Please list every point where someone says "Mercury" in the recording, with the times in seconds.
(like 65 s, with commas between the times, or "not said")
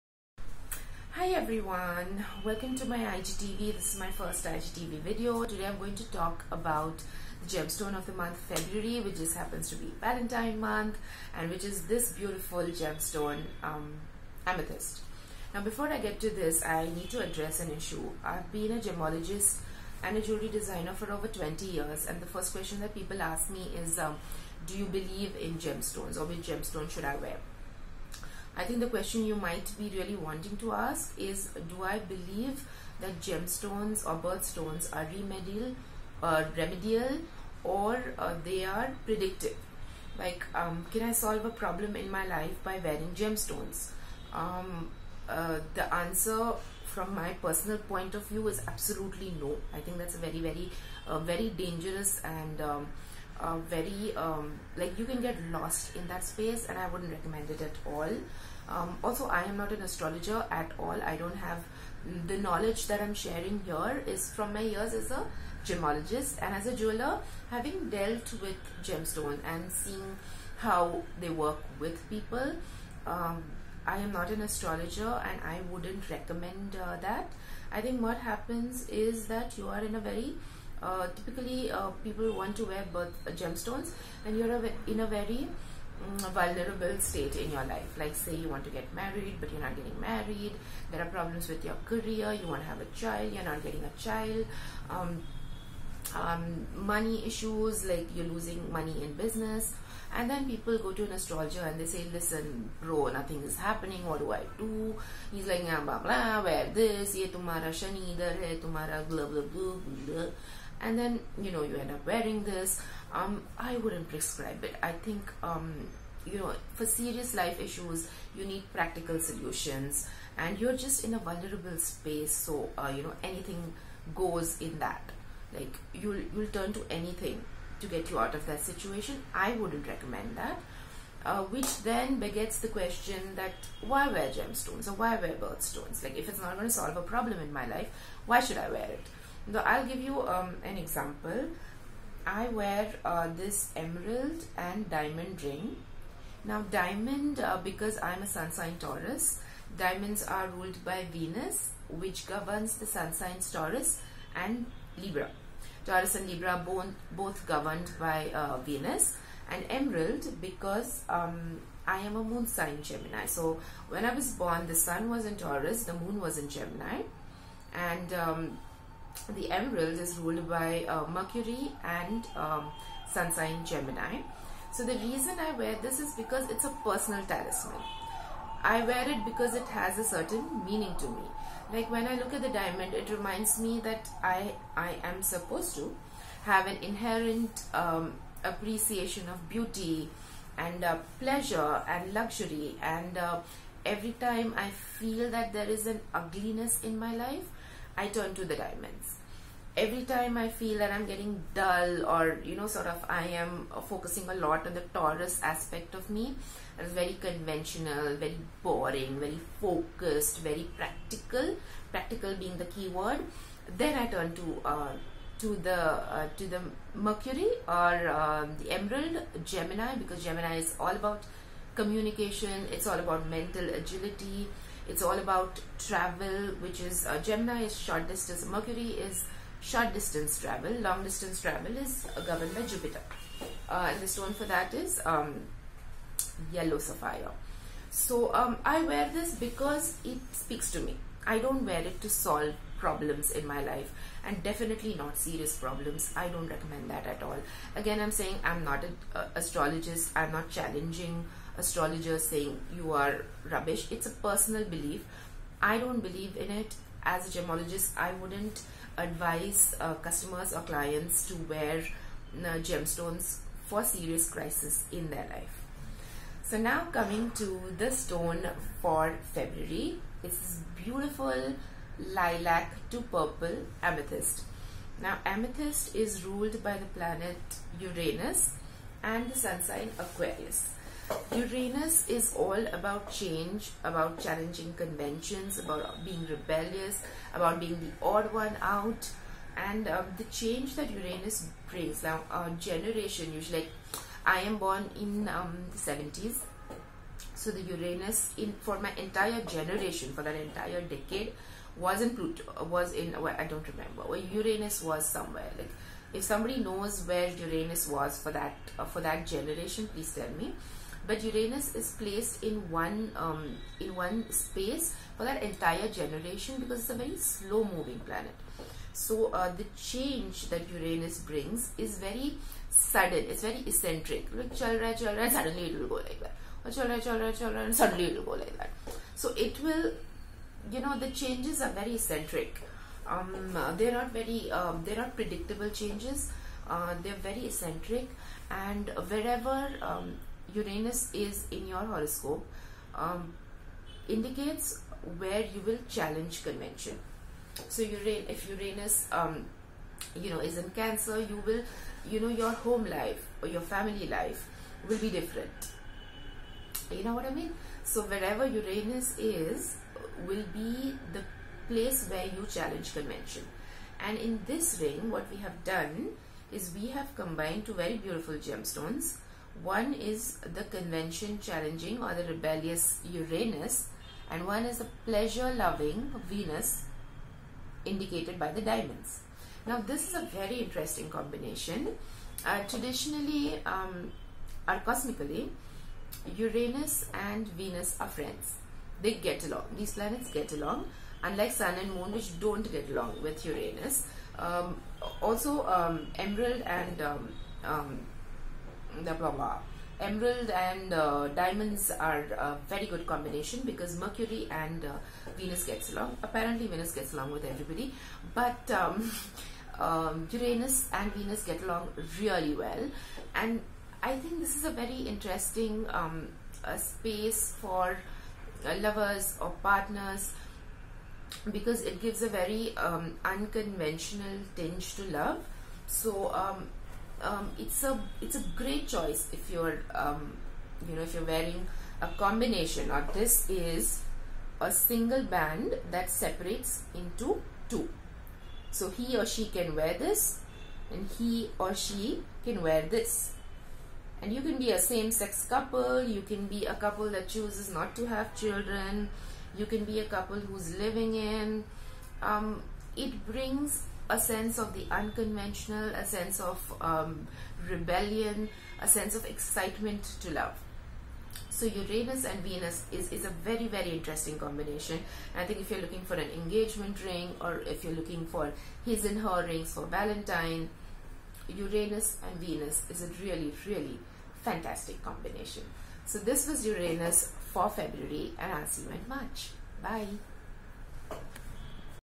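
171 s, 217 s, 228 s, 403 s.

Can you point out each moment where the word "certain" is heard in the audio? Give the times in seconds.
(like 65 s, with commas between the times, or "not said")
180 s.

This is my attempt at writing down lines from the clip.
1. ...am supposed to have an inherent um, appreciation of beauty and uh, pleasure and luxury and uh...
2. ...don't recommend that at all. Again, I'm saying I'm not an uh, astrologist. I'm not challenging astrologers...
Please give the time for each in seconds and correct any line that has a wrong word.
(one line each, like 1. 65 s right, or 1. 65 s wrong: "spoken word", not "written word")
1. 185 s right
2. 246 s right.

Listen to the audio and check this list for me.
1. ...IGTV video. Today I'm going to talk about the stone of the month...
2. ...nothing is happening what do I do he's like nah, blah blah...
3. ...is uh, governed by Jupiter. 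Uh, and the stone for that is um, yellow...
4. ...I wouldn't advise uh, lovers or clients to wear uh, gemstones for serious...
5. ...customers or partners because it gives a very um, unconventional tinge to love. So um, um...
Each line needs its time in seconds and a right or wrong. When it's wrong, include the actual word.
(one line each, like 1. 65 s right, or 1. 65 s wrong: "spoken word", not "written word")
1. 4 s wrong: "gemstone", not "stone"
2. 103 s right
3. 231 s right
4. 257 s wrong: "customers", not "lovers"
5. 418 s wrong: "lovers", not "customers".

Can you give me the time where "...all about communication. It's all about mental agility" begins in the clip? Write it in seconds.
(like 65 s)
220 s.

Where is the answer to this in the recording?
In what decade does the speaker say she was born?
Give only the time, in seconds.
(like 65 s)
295 s.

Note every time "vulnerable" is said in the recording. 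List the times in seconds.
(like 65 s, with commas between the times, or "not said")
86 s, 121 s.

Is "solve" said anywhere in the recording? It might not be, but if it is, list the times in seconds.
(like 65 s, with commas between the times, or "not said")
41 s, 136 s, 242 s.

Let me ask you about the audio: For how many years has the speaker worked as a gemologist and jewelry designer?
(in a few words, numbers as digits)
over 20 years.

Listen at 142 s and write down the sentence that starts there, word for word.
I wear uh, this emerald and diamond ring.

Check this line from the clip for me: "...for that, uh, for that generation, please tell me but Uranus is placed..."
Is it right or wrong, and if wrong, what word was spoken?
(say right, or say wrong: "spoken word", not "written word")
right.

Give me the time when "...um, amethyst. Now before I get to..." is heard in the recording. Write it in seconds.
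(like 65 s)
13 s.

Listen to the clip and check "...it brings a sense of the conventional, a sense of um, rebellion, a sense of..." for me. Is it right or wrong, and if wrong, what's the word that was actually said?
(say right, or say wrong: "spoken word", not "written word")
wrong: "unconventional", not "conventional".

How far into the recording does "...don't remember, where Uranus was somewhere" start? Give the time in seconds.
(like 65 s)
303 s.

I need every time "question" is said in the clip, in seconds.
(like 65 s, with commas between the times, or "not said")
22 s, 28 s, 132 s.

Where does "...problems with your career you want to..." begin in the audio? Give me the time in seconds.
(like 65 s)
91 s.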